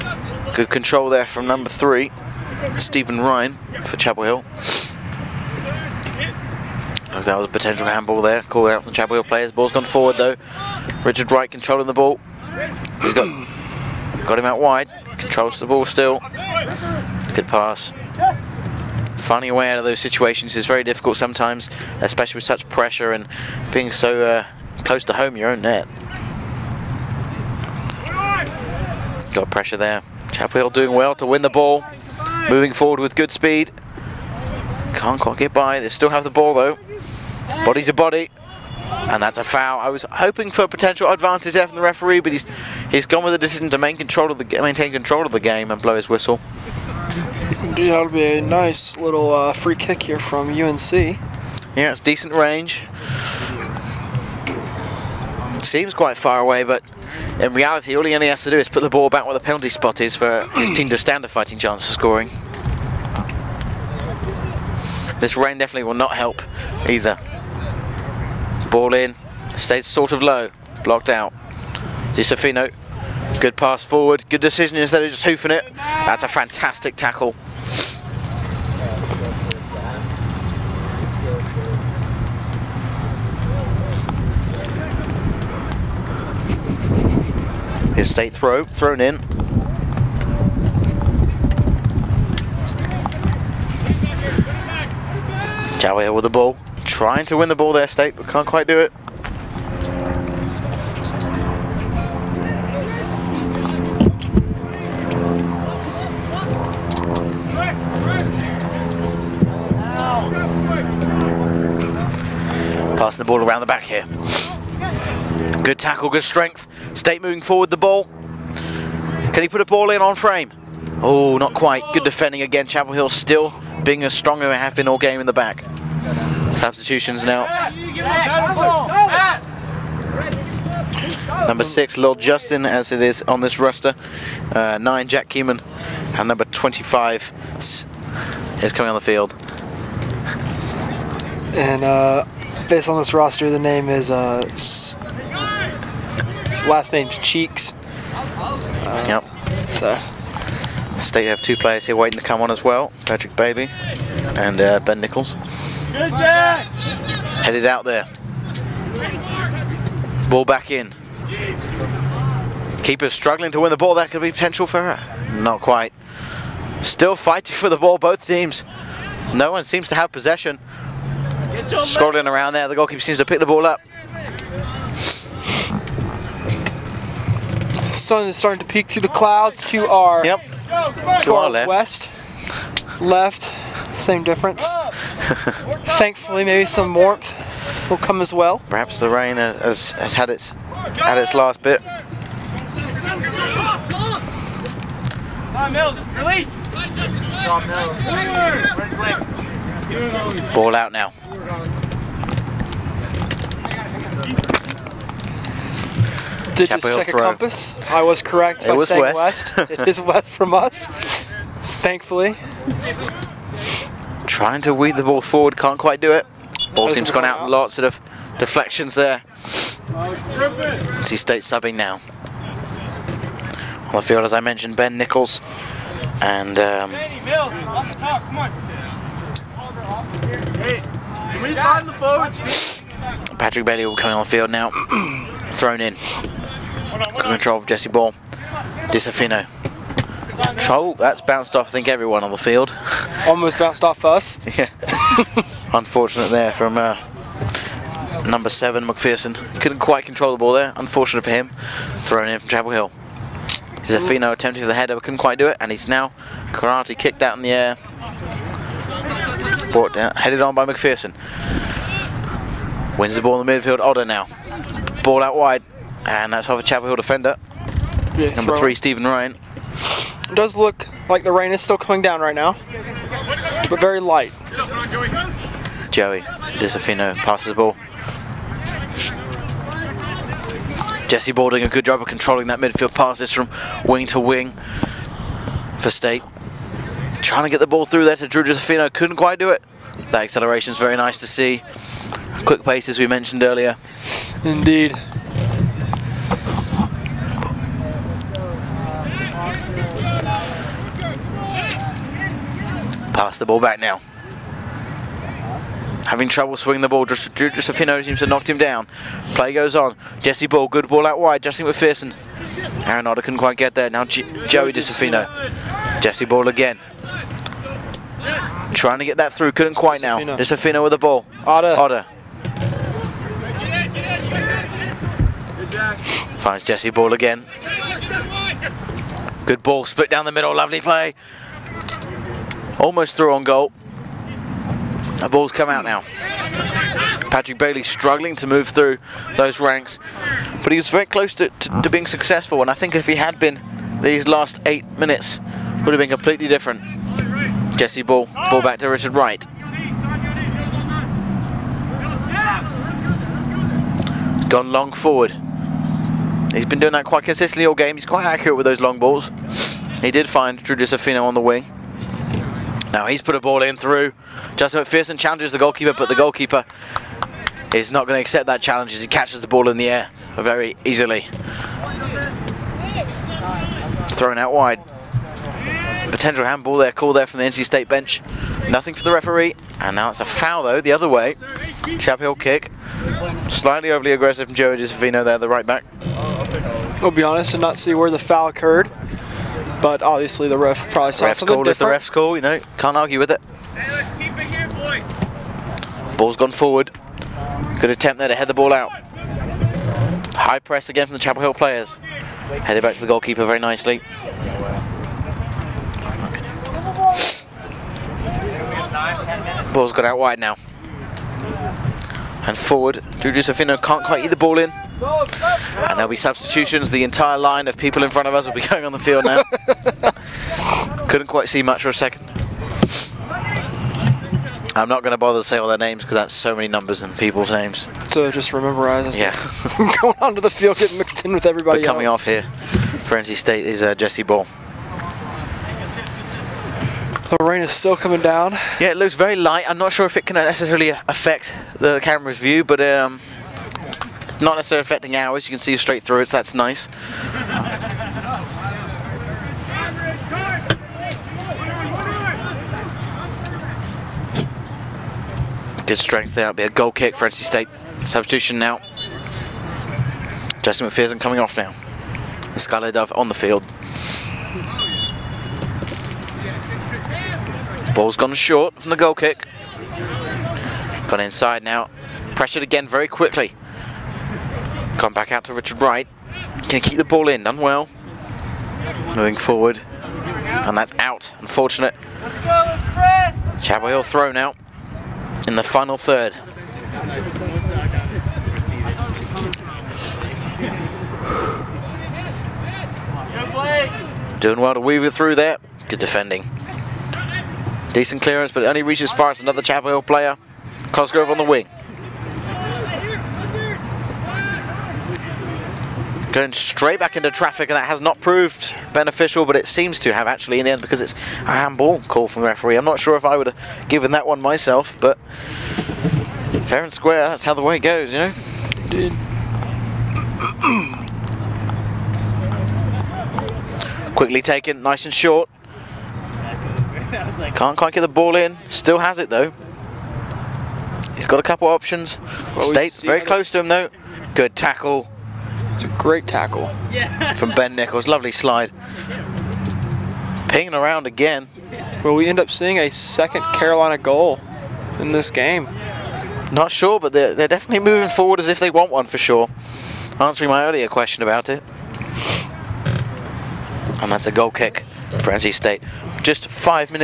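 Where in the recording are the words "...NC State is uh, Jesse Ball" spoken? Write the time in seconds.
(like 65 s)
433 s.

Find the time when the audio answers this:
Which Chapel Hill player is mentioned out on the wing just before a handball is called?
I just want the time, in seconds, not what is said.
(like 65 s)
500 s.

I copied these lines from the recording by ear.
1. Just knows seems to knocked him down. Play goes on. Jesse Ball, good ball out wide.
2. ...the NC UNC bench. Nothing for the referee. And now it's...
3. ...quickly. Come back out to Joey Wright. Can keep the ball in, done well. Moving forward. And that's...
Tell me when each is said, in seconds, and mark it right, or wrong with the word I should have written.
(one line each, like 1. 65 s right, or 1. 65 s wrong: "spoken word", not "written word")
1. 307 s right
2. 377 s wrong: "State", not "UNC"
3. 473 s wrong: "Richard", not "Joey".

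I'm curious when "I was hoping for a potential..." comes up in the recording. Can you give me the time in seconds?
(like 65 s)
39 s.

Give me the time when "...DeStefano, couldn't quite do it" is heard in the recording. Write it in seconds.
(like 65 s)
288 s.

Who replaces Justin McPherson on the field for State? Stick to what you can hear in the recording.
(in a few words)
Skylar Dove.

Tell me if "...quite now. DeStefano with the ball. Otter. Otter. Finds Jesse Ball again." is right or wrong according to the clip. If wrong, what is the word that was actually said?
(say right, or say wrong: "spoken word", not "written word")
right.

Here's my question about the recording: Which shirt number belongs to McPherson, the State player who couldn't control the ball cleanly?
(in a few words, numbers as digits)
7.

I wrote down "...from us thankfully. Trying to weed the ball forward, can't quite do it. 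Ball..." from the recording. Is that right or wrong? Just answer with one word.
right.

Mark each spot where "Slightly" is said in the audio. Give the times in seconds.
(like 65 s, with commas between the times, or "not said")
383 s.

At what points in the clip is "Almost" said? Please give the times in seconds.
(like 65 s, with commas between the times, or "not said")
243 s, 332 s.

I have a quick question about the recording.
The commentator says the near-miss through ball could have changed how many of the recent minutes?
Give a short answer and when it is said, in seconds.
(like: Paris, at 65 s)
8, at 344 s.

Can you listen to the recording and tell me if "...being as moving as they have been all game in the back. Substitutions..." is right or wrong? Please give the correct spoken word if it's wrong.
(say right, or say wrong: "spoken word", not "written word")
wrong: "strong", not "moving".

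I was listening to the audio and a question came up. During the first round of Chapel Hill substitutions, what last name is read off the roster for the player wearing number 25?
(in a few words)
Cheeks.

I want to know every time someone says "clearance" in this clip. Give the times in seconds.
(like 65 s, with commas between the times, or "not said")
498 s.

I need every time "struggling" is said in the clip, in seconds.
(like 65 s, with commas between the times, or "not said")
163 s, 337 s.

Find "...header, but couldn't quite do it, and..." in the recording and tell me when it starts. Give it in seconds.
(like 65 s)
254 s.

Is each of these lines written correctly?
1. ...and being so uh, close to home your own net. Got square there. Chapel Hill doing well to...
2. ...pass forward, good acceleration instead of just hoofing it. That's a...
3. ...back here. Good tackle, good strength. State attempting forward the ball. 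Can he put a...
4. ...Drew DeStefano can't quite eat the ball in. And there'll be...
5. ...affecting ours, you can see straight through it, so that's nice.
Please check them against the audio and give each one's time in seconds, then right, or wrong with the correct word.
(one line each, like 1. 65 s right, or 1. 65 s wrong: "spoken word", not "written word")
1. 23 s wrong: "pressure", not "square"
2. 73 s wrong: "decision", not "acceleration"
3. 113 s wrong: "moving", not "attempting"
4. 413 s right
5. 444 s right.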